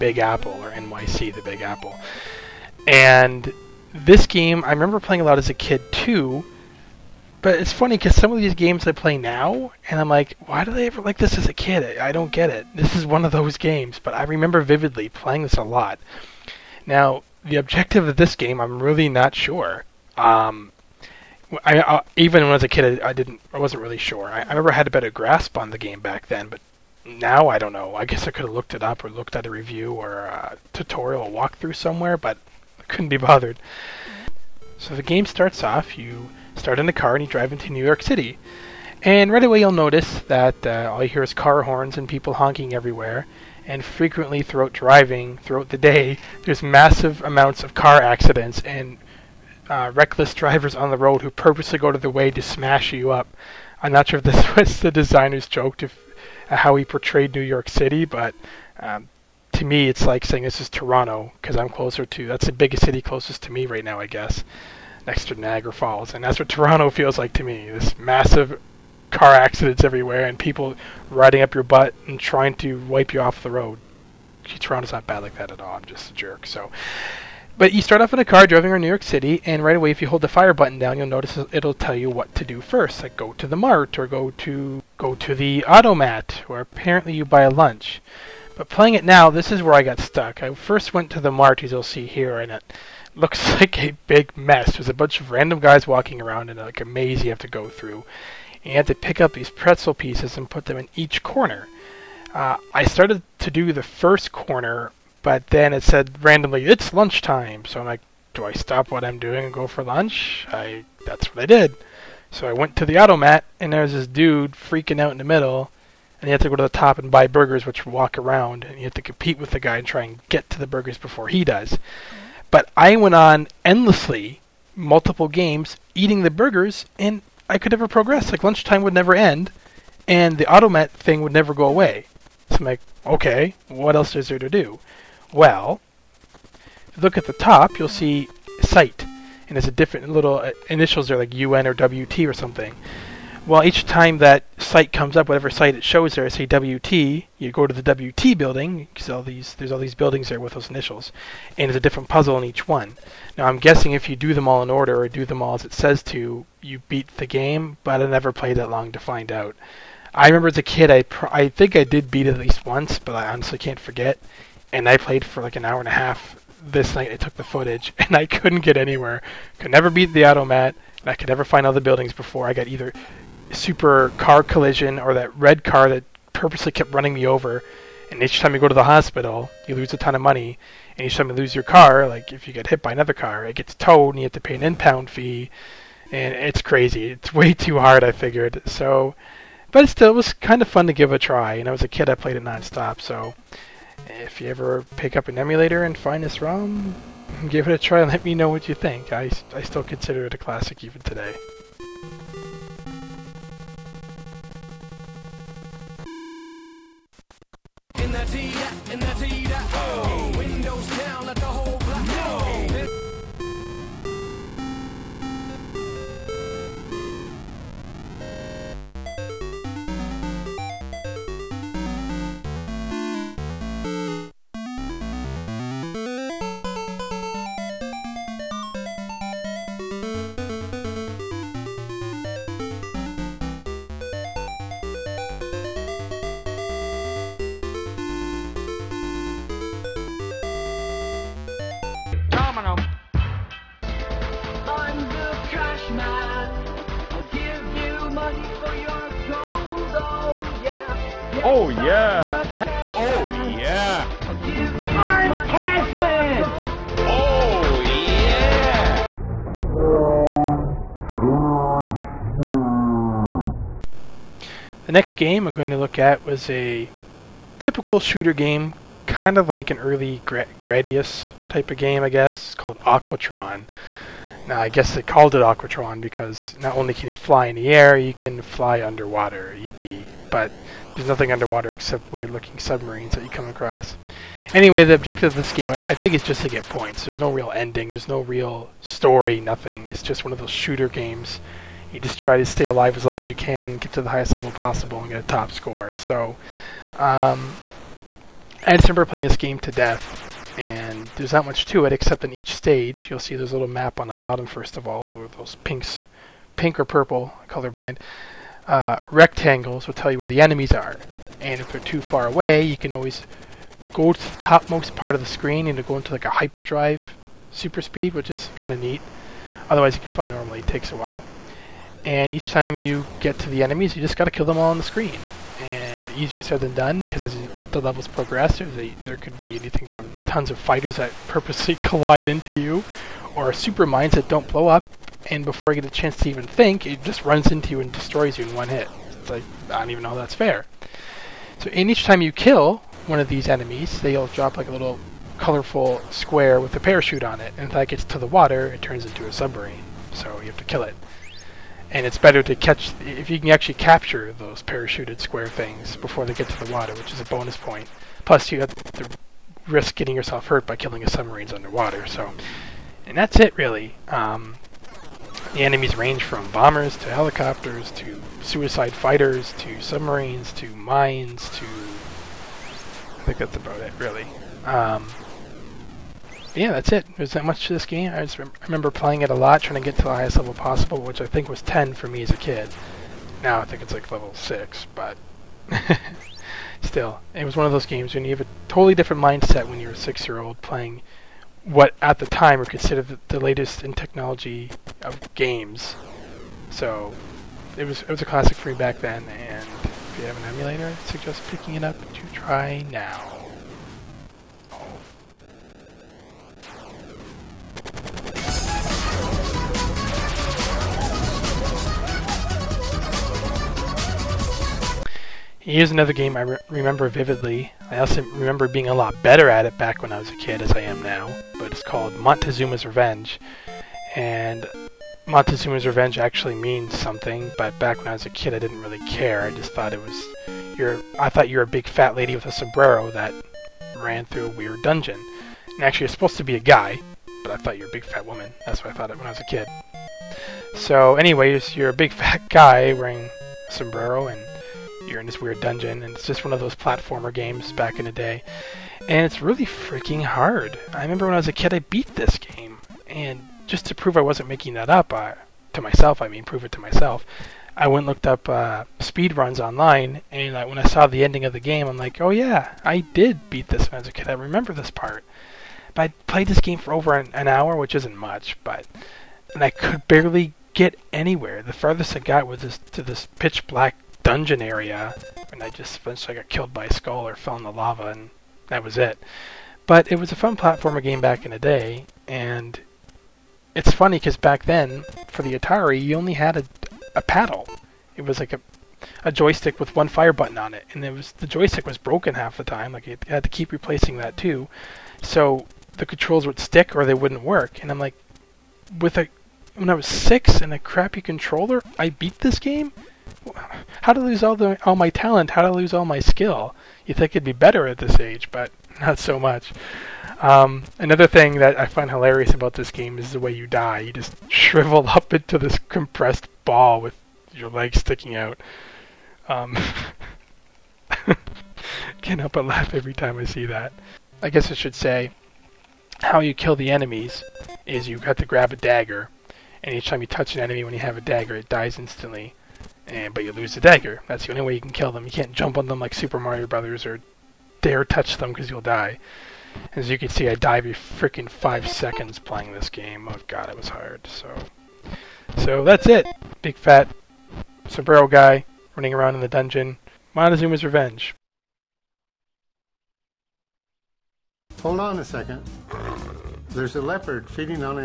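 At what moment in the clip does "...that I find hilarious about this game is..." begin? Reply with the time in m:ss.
8:31.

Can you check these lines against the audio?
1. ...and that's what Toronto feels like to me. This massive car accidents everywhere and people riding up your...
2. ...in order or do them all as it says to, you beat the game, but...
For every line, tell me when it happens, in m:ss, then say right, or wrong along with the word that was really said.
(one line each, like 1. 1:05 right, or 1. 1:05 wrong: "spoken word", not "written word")
1. 1:06 right
2. 2:34 right.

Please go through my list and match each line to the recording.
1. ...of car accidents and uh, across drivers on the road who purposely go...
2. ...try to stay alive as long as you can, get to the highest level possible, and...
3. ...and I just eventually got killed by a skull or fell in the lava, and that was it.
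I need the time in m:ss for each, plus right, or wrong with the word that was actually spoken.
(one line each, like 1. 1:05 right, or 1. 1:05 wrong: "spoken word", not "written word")
1. 0:47 wrong: "reckless", not "across"
2. 4:52 right
3. 7:55 right.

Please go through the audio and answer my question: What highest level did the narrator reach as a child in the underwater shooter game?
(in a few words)
10.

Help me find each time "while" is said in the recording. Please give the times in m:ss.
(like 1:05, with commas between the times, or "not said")
5:20.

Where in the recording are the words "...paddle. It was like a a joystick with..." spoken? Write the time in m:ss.
8:07.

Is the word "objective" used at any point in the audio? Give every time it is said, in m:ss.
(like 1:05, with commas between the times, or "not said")
0:17, 4:44.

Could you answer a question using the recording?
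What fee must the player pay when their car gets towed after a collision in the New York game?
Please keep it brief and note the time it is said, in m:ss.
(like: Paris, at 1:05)
impound fee, at 3:04.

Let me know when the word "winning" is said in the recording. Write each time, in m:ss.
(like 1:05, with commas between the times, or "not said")
not said.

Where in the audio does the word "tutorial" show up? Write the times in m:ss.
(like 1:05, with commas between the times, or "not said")
0:30.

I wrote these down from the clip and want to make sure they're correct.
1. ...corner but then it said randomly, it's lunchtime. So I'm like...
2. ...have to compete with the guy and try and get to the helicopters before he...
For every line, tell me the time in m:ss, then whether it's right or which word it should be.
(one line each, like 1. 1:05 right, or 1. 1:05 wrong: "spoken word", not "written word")
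1. 1:44 right
2. 1:58 wrong: "burgers", not "helicopters".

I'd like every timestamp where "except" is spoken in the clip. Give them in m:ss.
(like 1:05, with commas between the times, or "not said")
4:41, 5:01.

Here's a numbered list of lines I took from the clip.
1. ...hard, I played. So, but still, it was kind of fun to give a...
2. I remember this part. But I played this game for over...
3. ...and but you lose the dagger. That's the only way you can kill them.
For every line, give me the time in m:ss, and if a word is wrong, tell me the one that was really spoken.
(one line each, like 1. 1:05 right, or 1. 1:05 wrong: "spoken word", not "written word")
1. 3:07 wrong: "figured", not "played"
2. 7:44 right
3. 8:53 right.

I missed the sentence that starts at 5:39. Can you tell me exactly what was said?
It's like, I don't even know that's fair.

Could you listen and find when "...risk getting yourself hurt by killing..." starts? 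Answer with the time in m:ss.
5:59.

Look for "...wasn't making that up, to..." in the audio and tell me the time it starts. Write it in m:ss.
7:34.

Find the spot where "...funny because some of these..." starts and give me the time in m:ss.
0:07.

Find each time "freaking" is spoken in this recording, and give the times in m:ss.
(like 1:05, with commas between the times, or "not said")
1:54, 7:29, 9:00.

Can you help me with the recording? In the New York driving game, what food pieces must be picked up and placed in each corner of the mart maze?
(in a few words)
pretzel pieces.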